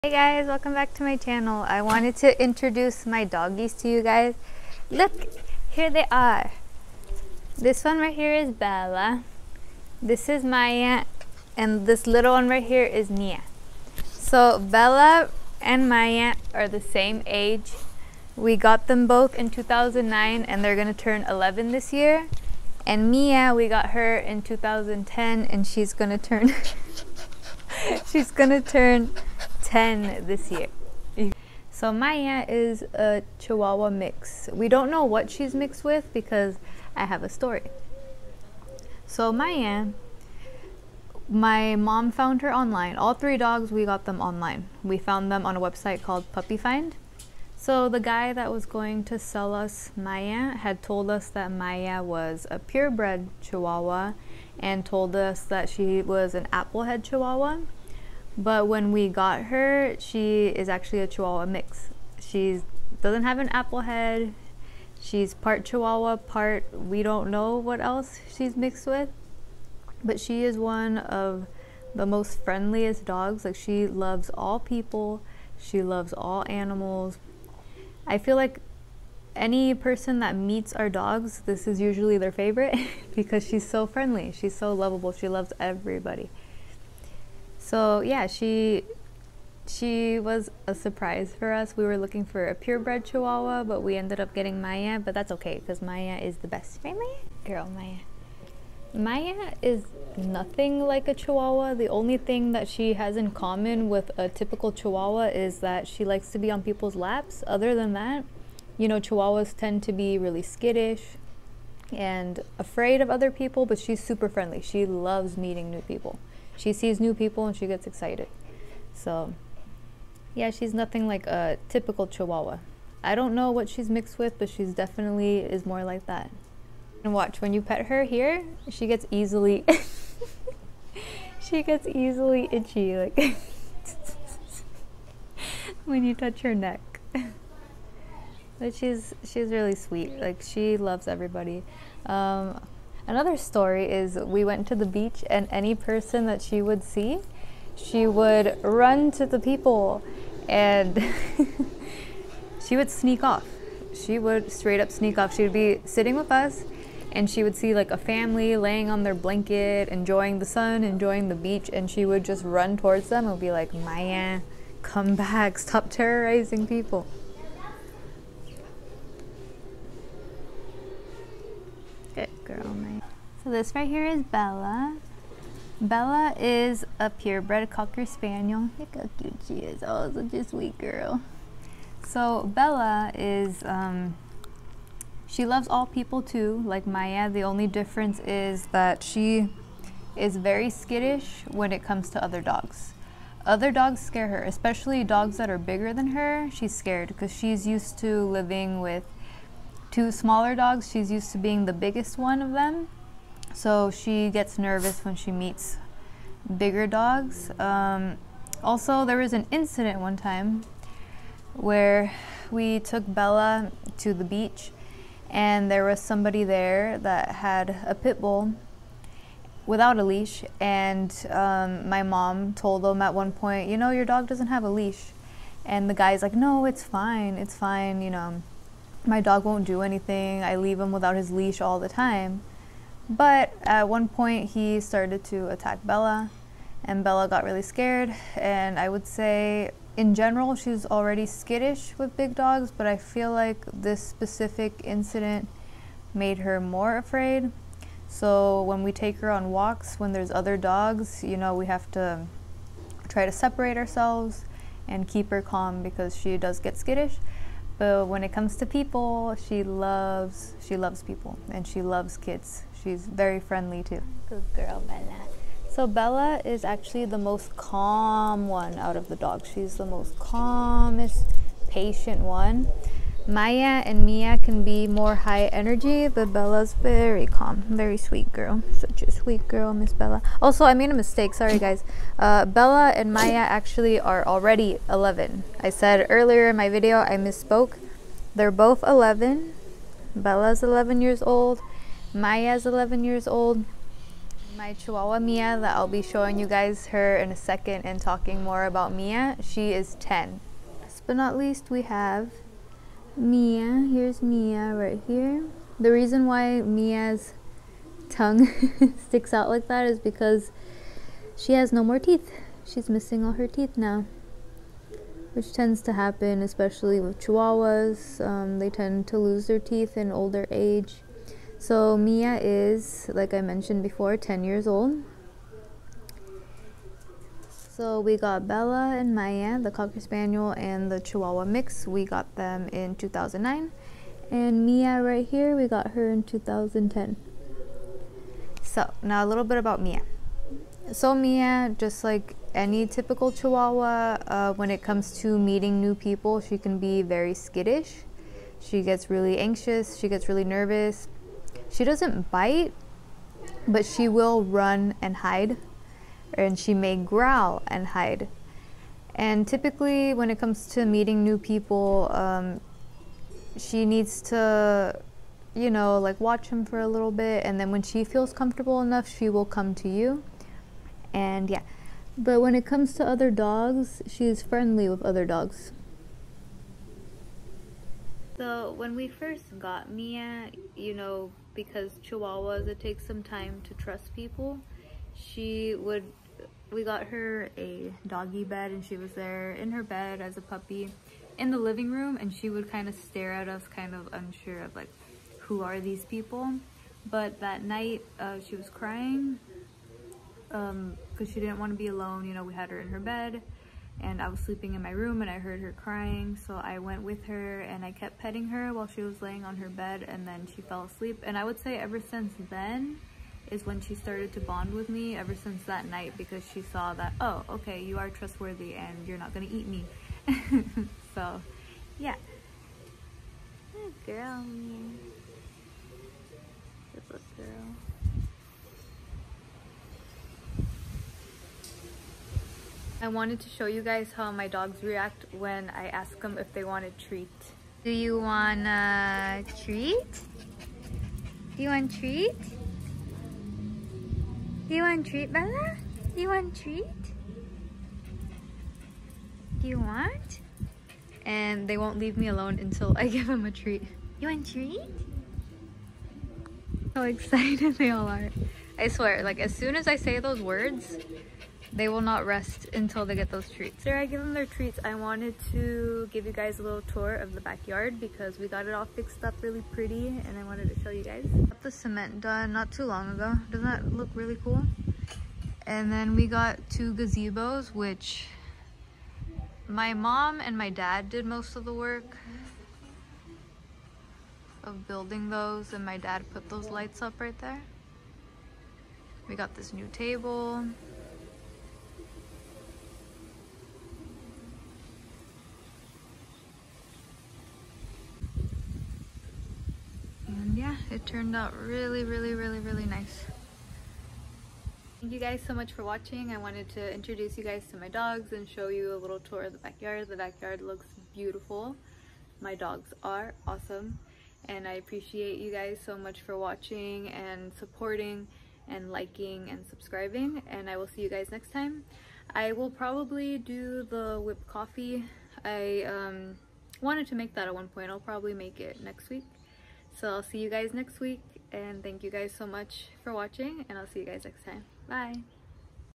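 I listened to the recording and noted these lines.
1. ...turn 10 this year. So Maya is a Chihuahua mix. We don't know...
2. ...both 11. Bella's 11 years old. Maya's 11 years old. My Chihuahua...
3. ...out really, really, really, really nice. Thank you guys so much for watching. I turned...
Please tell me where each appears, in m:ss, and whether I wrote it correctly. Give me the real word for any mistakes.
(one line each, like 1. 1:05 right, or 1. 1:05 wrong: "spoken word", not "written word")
1. 0:28 right
2. 4:48 right
3. 8:21 wrong: "wanted", not "turned".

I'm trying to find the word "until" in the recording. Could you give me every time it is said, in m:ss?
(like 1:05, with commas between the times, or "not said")
7:32, 7:42.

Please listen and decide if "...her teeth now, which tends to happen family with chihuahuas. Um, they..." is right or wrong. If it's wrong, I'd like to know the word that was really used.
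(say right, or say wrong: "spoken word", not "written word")
wrong: "especially", not "family".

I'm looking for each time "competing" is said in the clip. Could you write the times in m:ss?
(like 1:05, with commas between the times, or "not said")
not said.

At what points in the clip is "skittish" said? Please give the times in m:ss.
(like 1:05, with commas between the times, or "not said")
1:50, 3:10, 4:01, 4:16, 5:47.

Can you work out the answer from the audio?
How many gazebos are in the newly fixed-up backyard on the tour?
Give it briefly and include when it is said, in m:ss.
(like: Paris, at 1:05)
2, at 7:56.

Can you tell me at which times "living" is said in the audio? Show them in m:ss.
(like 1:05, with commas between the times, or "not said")
3:18, 6:31.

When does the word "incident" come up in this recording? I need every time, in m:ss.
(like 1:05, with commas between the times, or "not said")
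3:29, 4:04.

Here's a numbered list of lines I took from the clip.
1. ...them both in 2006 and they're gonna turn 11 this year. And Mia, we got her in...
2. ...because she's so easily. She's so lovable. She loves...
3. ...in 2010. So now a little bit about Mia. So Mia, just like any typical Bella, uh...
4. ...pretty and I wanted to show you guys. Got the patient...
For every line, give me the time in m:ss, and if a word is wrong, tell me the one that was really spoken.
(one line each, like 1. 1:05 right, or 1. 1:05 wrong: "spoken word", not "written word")
1. 0:18 wrong: "2009", not "2006"
2. 1:23 wrong: "friendly", not "easily"
3. 5:36 wrong: "Chihuahua", not "Bella"
4. 7:49 wrong: "cement", not "patient".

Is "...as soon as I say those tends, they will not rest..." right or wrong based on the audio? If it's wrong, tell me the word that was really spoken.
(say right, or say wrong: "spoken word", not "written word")
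wrong: "words", not "tends".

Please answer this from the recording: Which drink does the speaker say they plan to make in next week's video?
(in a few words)
whipped coffee.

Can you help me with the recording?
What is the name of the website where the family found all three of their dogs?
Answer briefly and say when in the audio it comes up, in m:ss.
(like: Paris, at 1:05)
PuppyFind, at 0:46.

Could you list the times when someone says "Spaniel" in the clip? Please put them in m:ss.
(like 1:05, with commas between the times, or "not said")
2:58, 5:30.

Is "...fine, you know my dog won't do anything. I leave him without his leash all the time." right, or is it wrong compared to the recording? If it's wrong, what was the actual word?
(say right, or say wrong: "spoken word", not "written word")
right.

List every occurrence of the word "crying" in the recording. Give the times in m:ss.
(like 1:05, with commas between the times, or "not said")
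6:38, 6:45.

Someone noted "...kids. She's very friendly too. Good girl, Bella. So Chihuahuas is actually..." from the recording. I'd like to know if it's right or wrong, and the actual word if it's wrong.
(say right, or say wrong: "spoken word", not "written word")
wrong: "Bella", not "Chihuahuas".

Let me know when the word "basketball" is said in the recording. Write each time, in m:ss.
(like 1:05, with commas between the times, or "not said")
not said.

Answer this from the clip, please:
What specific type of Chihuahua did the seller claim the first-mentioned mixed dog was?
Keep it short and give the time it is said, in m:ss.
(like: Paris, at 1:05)
applehead Chihuahua, at 0:56.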